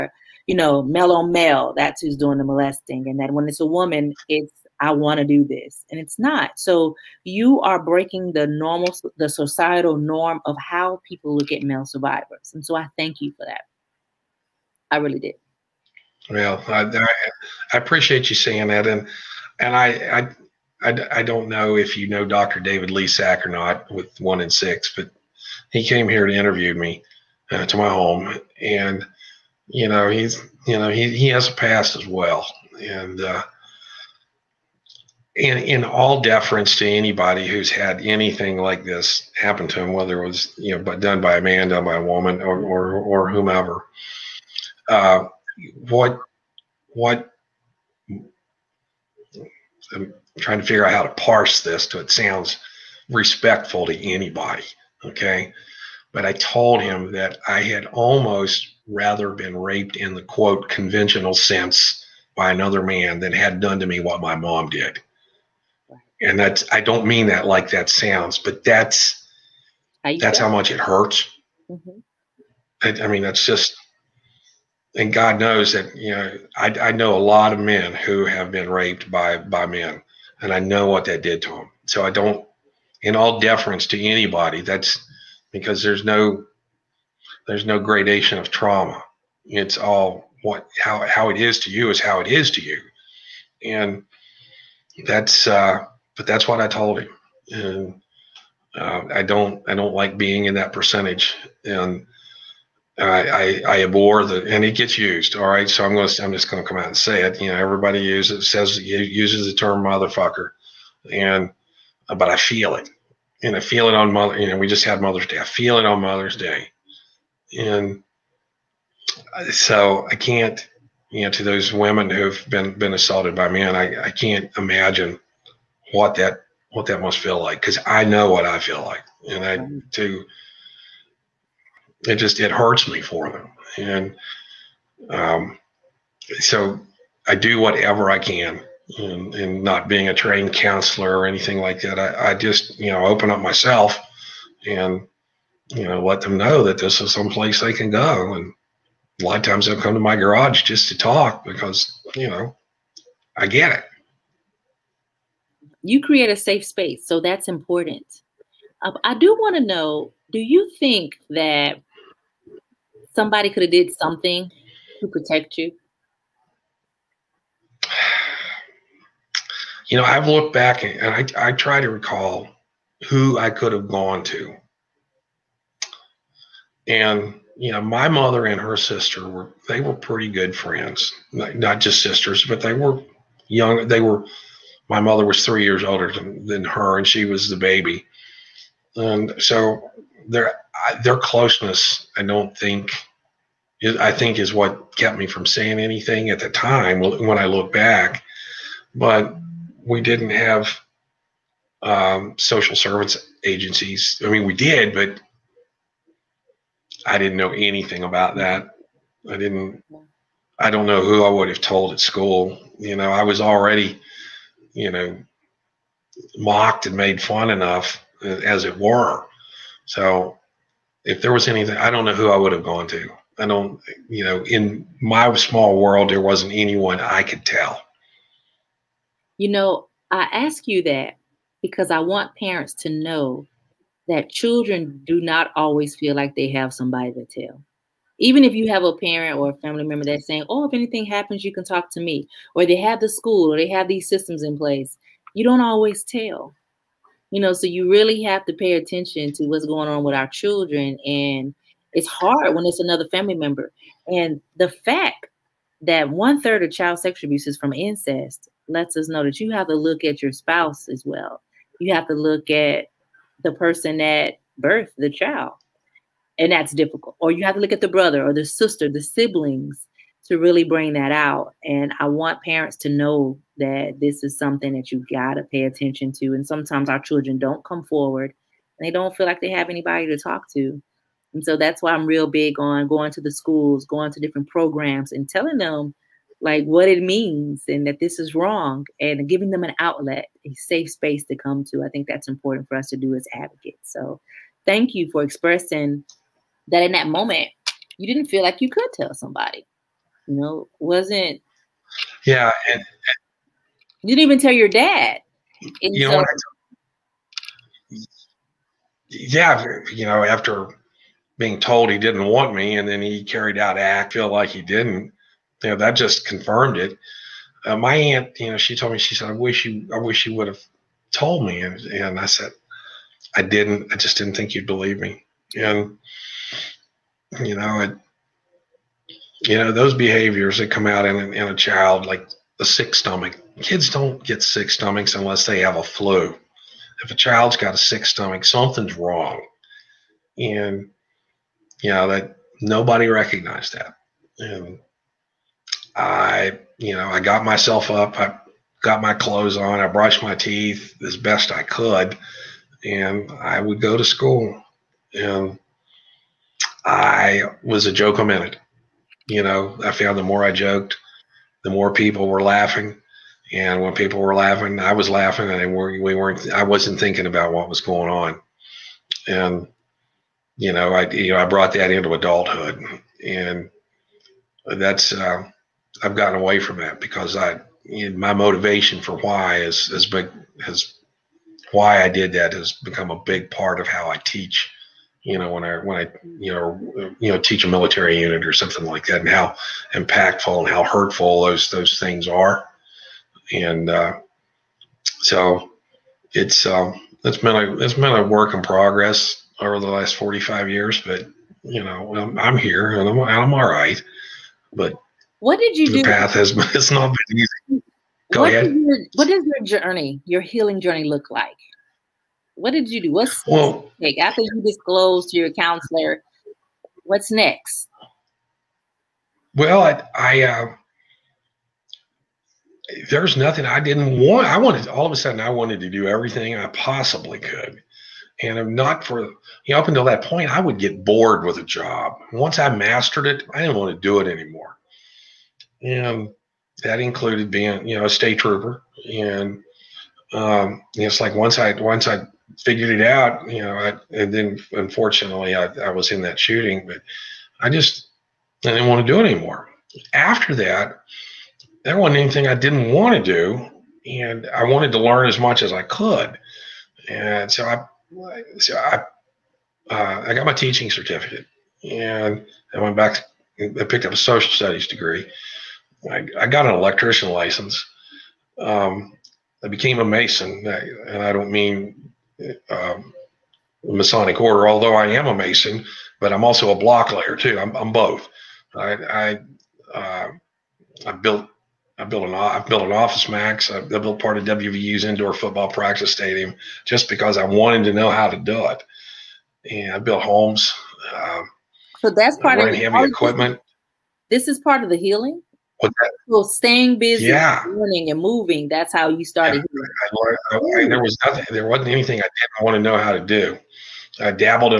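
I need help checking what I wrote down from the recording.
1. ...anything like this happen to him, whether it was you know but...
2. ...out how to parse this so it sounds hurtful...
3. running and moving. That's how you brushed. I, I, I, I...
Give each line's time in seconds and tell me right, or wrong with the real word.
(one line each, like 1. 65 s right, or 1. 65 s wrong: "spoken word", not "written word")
1. 38 s right
2. 50 s wrong: "respectful", not "hurtful"
3. 497 s wrong: "started", not "brushed".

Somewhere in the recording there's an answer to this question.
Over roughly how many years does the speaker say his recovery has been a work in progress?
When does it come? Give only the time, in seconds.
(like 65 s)
400 s.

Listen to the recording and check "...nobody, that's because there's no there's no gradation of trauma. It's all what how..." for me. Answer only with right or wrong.
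wrong.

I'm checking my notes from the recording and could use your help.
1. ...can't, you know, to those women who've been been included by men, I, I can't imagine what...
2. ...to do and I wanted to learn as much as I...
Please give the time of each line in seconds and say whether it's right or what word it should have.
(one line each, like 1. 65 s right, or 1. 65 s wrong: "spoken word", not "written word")
1. 120 s wrong: "assaulted", not "included"
2. 453 s right.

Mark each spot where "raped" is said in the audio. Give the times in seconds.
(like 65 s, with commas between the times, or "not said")
59 s, 78 s.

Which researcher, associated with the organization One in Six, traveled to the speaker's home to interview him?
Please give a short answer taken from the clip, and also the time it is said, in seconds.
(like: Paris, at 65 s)
Dr. David Lisak, at 22 s.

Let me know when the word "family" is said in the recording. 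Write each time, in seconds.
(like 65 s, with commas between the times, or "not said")
239 s, 253 s.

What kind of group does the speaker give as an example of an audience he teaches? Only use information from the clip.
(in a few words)
a military unit.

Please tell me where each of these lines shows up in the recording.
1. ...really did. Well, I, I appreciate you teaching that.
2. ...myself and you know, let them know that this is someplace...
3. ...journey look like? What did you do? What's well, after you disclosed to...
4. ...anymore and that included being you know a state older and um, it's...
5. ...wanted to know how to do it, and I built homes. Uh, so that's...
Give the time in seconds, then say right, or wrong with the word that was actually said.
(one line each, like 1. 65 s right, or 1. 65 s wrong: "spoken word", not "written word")
1. 14 s wrong: "saying", not "teaching"
2. 143 s right
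3. 410 s right
4. 434 s wrong: "trooper", not "older"
5. 487 s right.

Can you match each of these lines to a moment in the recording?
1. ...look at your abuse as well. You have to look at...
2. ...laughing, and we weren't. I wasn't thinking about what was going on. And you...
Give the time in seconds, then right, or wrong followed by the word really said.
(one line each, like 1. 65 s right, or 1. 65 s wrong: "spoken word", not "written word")
1. 259 s wrong: "spouse", not "abuse"
2. 365 s right.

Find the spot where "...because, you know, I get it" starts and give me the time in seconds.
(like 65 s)
151 s.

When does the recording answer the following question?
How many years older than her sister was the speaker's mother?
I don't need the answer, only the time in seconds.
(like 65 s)
185 s.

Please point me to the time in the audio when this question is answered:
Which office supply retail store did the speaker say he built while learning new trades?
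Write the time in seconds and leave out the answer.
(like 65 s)
482 s.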